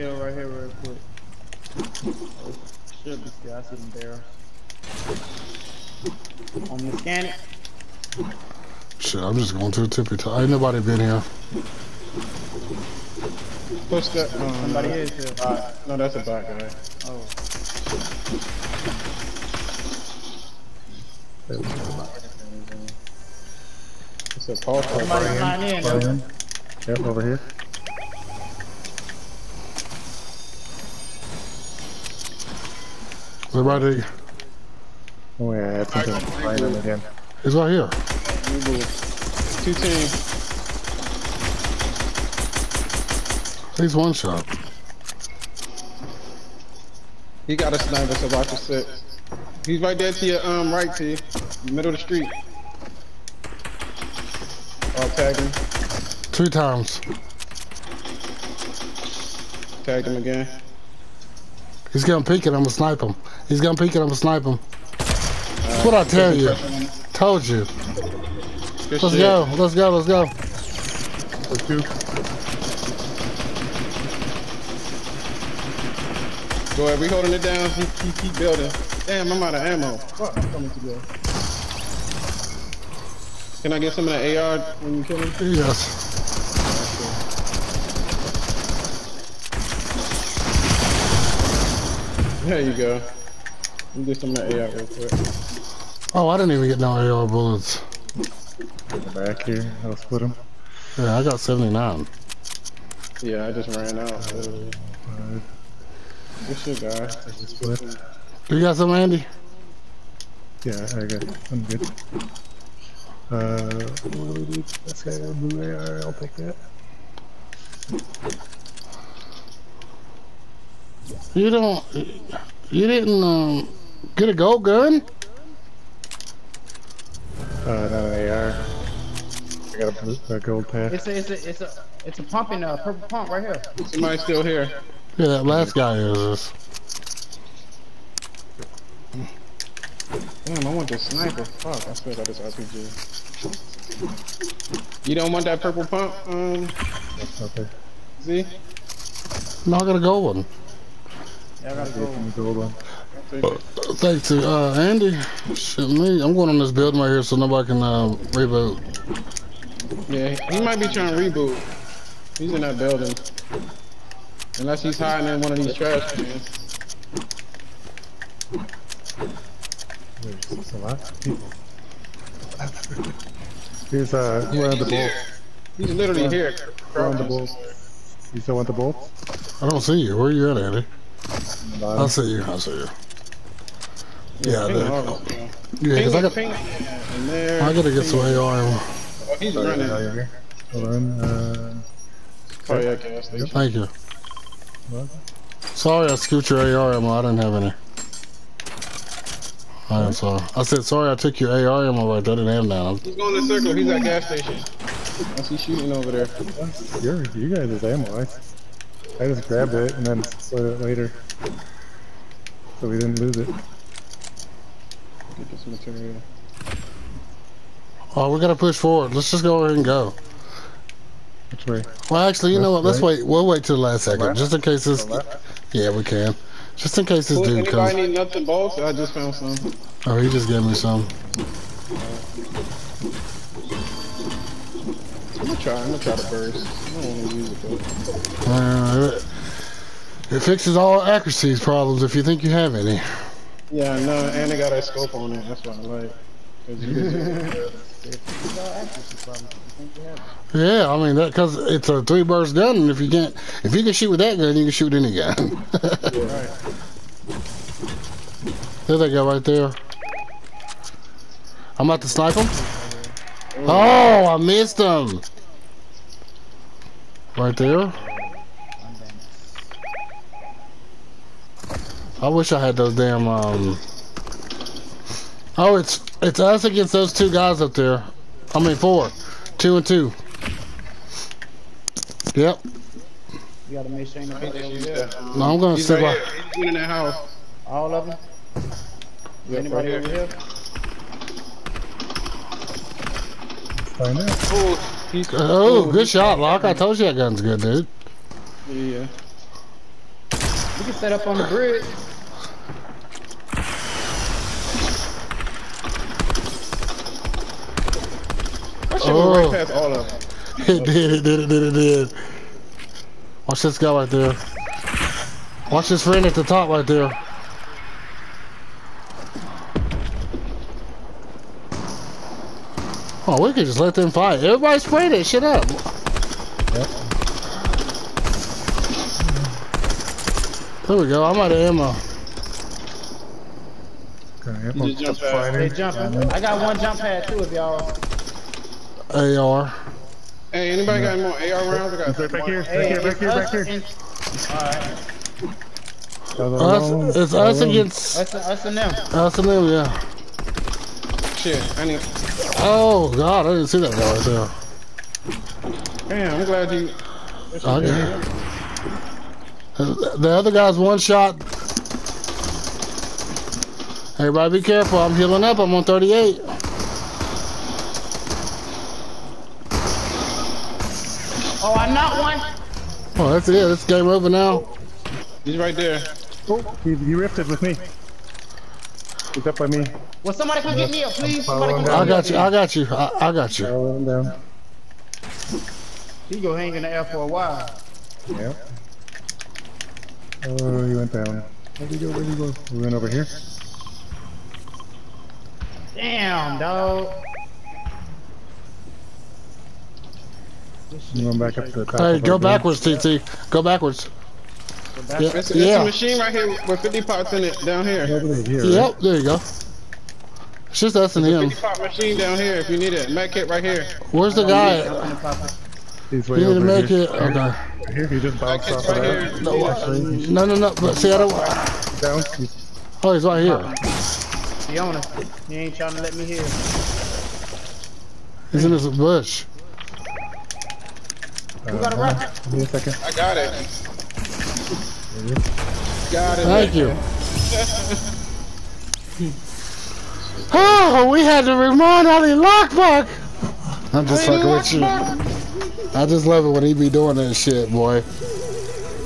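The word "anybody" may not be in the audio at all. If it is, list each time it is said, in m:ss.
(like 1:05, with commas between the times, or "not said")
4:49, 5:40.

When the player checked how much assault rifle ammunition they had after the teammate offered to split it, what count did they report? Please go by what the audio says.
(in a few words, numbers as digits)
79.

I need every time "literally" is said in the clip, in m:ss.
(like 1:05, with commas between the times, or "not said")
1:44, 2:55.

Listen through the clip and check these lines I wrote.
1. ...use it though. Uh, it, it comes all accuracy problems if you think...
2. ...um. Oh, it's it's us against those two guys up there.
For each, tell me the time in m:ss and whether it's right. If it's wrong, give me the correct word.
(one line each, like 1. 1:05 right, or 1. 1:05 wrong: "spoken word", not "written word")
1. 3:57 wrong: "fixes", not "comes"
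2. 4:33 right.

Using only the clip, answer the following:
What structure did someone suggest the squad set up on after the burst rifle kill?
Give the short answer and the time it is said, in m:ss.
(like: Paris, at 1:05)
The bridge, at 5:01.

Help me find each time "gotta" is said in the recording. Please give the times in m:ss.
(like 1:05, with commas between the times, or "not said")
3:07, 4:43.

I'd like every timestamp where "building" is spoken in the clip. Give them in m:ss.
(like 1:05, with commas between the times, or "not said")
1:18, 2:36, 2:42.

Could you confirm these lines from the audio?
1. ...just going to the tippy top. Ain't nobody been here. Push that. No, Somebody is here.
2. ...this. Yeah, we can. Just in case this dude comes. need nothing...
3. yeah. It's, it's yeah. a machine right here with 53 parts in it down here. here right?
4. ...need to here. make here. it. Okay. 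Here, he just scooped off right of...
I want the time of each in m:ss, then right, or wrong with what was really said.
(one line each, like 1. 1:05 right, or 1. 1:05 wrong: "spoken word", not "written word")
1. 0:09 right
2. 3:44 right
3. 6:45 wrong: "50", not "53"
4. 6:56 wrong: "bounced", not "scooped".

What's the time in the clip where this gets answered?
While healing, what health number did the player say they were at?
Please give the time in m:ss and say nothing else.
6:05.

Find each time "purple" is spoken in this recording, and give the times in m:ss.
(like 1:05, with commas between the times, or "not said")
2:12, 2:25.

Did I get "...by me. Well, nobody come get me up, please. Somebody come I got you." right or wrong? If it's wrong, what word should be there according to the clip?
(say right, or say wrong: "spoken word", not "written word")
wrong: "somebody", not "nobody".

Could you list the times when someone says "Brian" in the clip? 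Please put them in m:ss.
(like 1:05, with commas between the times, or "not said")
0:25.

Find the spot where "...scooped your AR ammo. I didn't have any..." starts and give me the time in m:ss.
3:16.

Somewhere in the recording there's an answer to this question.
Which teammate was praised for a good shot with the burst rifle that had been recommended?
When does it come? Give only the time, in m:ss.
4:56.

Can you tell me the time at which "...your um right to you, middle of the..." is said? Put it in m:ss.
0:50.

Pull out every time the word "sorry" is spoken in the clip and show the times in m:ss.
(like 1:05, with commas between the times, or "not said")
3:15, 3:20.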